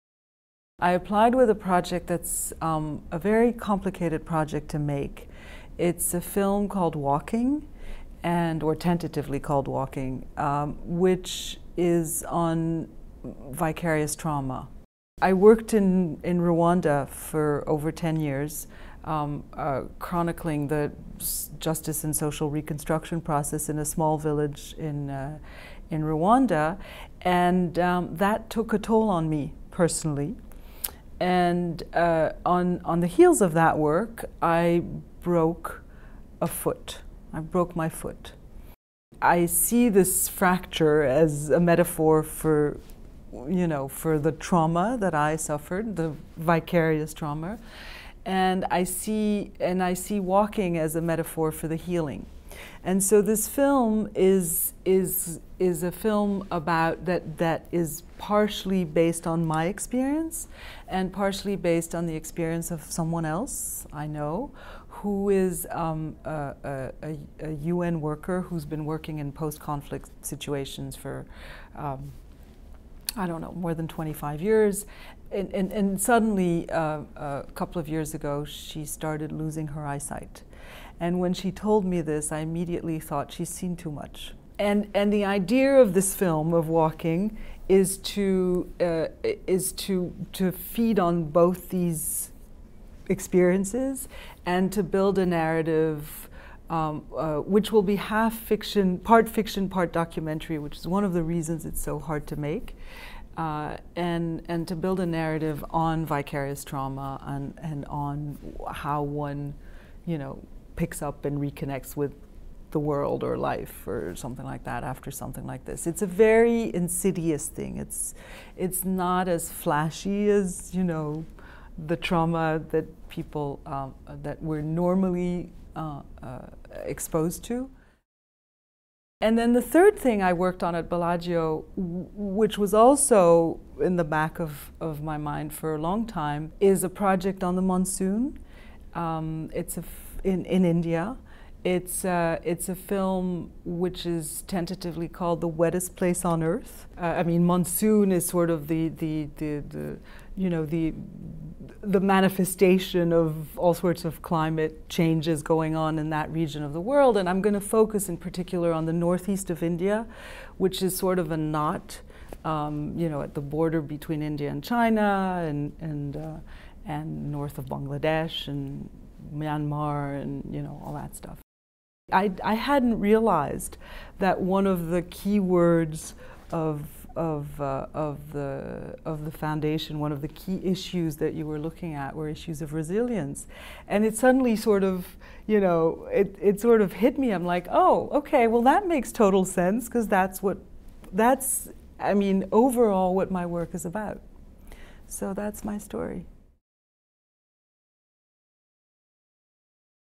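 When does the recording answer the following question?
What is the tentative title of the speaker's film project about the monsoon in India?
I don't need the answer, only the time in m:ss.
2:25.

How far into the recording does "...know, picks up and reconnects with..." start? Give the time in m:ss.
1:50.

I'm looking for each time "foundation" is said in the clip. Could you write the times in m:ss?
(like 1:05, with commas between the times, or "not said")
2:59.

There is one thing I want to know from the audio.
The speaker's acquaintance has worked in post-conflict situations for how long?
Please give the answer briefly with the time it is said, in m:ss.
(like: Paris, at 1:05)
more than 25 years, at 1:13.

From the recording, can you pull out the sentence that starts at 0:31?
And uh, on, on the heels of that work, I broke a foot.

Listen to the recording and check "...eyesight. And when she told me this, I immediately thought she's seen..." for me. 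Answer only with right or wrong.
right.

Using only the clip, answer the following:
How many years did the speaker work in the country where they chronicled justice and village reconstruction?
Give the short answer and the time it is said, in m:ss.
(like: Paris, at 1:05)
over 10 years, at 0:17.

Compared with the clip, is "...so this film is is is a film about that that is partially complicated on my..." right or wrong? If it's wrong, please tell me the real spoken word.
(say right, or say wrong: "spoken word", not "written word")
wrong: "based", not "complicated".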